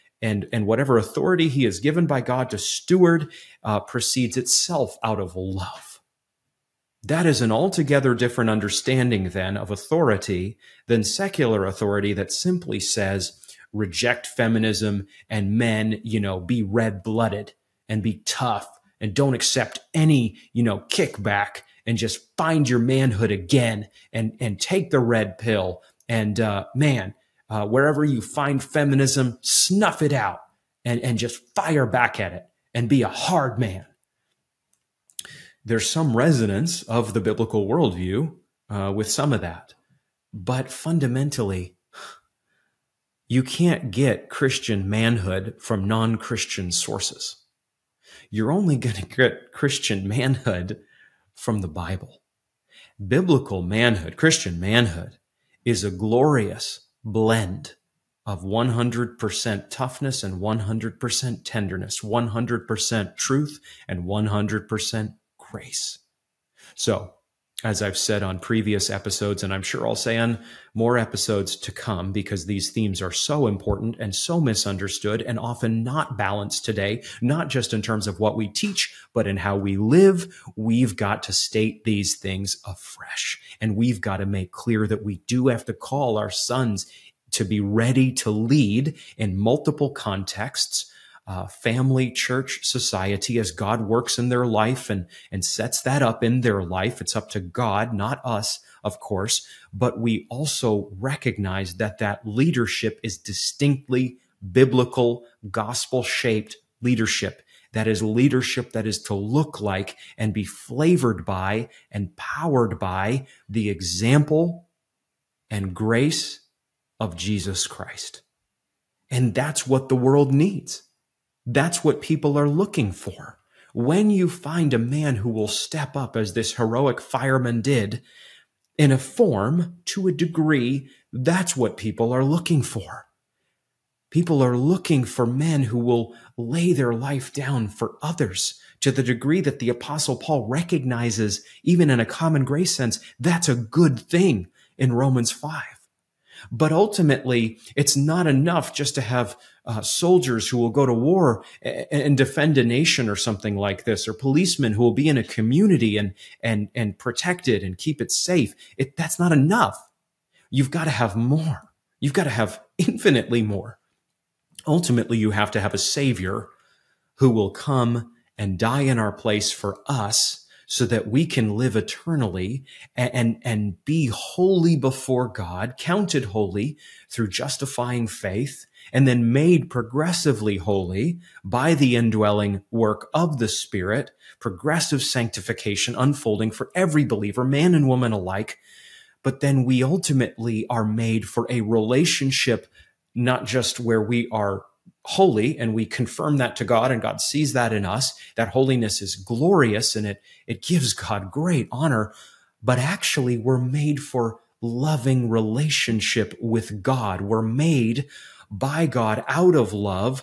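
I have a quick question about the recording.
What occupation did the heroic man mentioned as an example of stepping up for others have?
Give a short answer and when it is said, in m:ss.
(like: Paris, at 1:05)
fireman, at 2:07.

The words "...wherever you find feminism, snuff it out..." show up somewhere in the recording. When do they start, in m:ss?
0:27.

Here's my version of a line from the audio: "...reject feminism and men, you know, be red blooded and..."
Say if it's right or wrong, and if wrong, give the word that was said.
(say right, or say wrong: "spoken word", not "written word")
right.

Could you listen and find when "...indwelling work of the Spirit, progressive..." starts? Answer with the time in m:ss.
3:01.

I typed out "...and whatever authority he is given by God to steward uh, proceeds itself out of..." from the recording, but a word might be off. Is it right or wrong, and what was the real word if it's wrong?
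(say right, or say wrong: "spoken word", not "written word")
right.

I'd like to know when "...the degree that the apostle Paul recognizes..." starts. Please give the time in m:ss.
2:18.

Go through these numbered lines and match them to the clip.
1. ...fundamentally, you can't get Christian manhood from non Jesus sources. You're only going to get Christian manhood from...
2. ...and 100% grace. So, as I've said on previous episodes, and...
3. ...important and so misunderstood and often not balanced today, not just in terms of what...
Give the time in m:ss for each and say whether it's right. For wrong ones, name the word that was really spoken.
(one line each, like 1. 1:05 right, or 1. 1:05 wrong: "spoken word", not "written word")
1. 0:40 wrong: "Christian", not "Jesus"
2. 1:03 right
3. 1:13 right.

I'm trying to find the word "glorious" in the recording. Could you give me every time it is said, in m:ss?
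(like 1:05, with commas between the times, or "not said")
0:55, 3:19.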